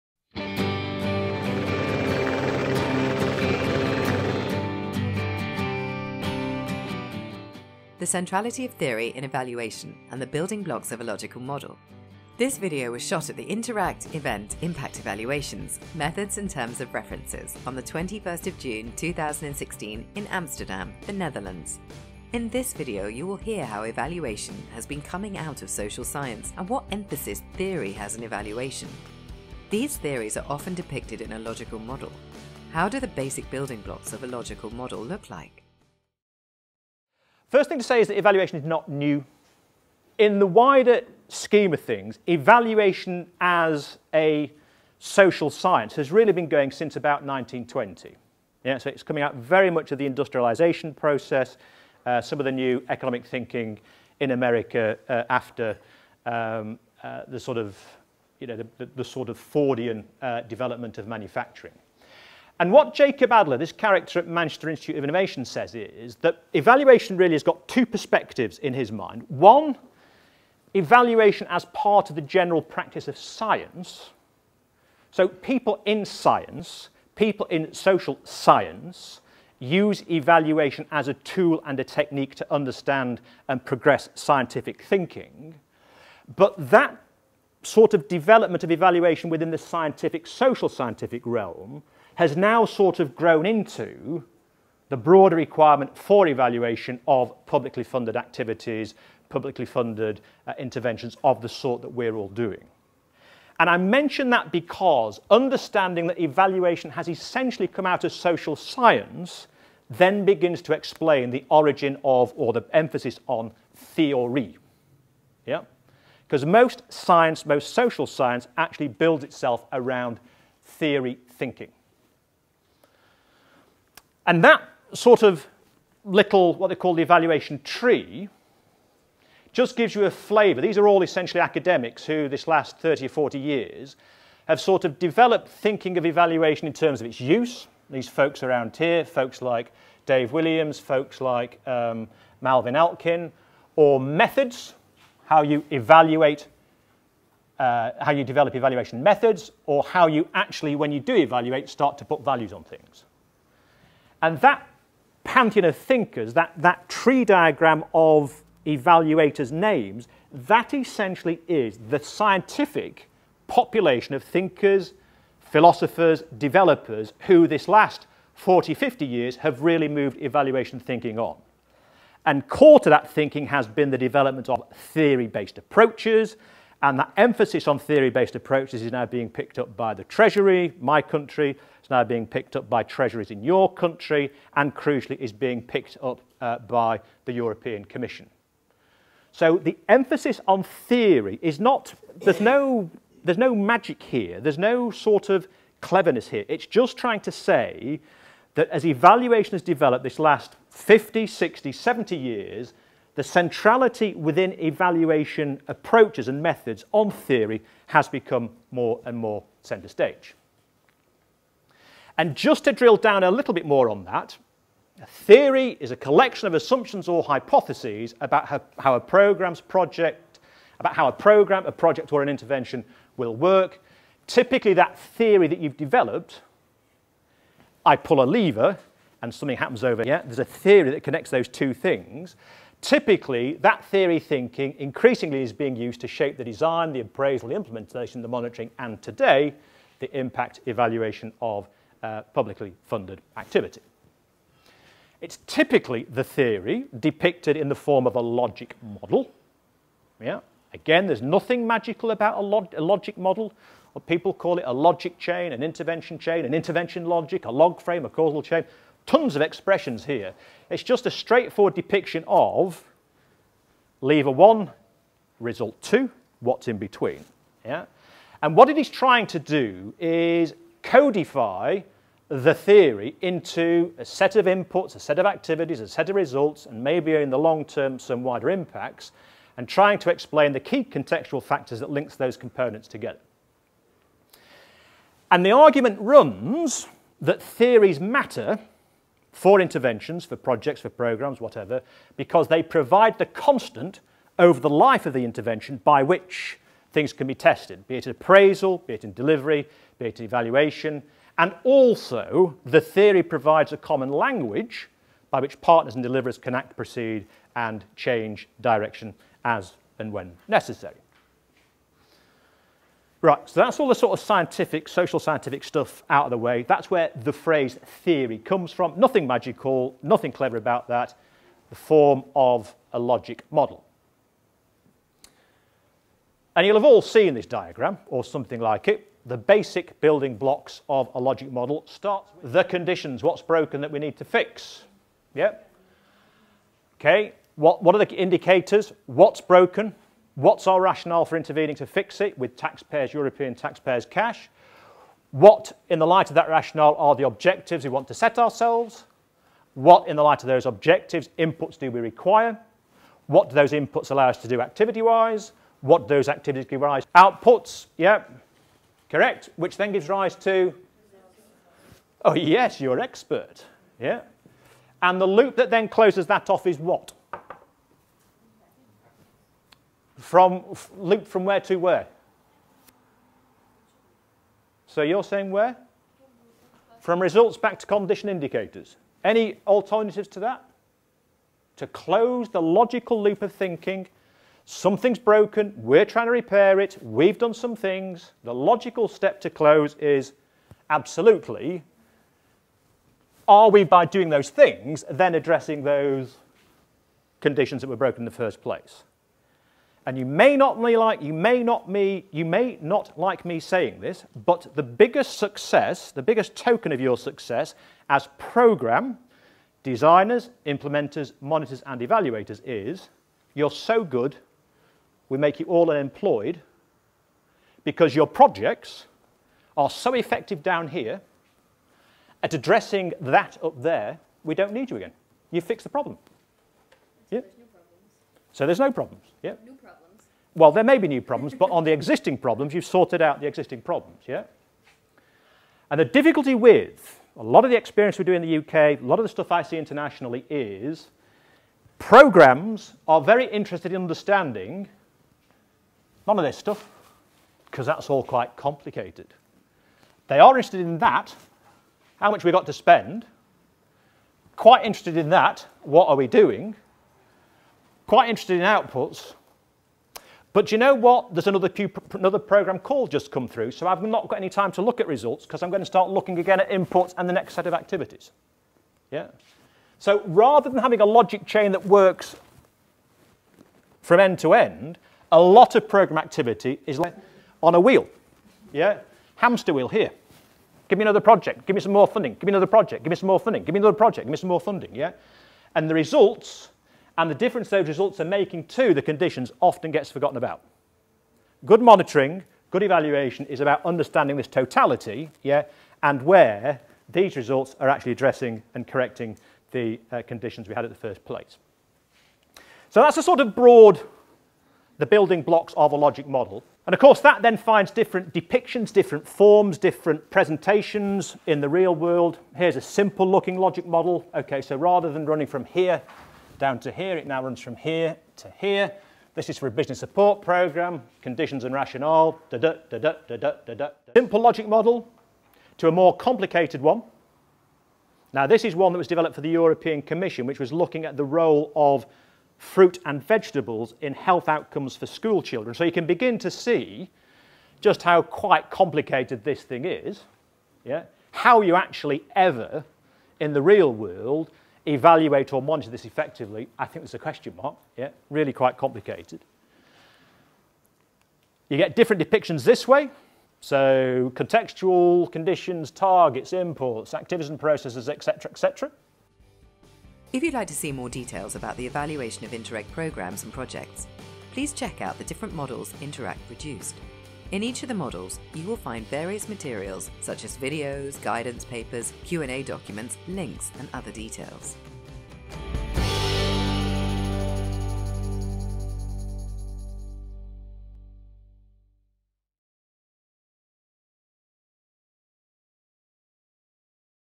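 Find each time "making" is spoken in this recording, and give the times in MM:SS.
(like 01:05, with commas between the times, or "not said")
08:08.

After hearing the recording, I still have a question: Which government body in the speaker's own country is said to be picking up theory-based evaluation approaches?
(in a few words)
the Treasury.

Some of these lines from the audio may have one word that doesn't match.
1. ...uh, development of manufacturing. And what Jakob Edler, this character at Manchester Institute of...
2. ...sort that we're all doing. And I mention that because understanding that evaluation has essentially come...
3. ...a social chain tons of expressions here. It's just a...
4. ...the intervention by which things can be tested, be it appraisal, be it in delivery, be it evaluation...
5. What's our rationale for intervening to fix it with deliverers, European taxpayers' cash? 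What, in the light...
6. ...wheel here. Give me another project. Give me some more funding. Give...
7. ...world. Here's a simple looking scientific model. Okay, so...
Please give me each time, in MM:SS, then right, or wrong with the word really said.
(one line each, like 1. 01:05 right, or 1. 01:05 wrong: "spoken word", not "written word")
1. 01:00 right
2. 01:41 right
3. 04:18 wrong: "causal", not "social"
4. 04:55 right
5. 05:40 wrong: "taxpayers", not "deliverers"
6. 07:59 right
7. 08:31 wrong: "logic", not "scientific".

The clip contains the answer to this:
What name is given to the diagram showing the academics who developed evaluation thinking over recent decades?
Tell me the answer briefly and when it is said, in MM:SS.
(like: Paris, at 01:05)
the evaluation tree, at 02:07.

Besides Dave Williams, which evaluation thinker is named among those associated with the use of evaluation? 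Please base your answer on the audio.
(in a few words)
Marvin Alkin.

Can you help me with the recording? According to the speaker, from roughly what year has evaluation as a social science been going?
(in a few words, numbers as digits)
1920.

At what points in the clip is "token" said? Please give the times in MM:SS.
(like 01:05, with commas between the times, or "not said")
06:46.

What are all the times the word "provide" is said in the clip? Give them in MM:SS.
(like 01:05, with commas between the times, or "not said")
04:52, 05:03.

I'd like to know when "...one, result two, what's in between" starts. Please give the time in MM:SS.
04:24.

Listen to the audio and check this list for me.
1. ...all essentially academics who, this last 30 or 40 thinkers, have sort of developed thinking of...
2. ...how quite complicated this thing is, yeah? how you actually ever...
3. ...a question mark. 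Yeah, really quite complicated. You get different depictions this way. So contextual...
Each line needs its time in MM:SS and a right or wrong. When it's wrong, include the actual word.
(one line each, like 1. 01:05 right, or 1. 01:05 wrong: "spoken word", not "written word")
1. 02:10 wrong: "years", not "thinkers"
2. 08:58 right
3. 09:07 right.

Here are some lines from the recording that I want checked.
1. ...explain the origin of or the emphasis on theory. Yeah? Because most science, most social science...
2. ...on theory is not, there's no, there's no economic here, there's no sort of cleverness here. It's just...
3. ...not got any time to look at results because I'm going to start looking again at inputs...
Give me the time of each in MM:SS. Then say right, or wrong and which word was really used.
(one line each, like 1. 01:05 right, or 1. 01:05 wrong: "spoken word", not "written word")
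1. 01:50 right
2. 03:10 wrong: "magic", not "economic"
3. 07:44 right.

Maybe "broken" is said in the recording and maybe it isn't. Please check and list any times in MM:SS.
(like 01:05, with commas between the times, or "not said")
05:33, 05:39, 06:25, 06:37.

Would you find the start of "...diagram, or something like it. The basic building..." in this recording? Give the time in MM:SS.
05:27.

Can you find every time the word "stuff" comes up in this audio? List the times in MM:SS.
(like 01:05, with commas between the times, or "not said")
05:15, 07:19, 07:26.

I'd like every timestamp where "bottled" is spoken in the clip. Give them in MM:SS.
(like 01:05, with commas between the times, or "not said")
not said.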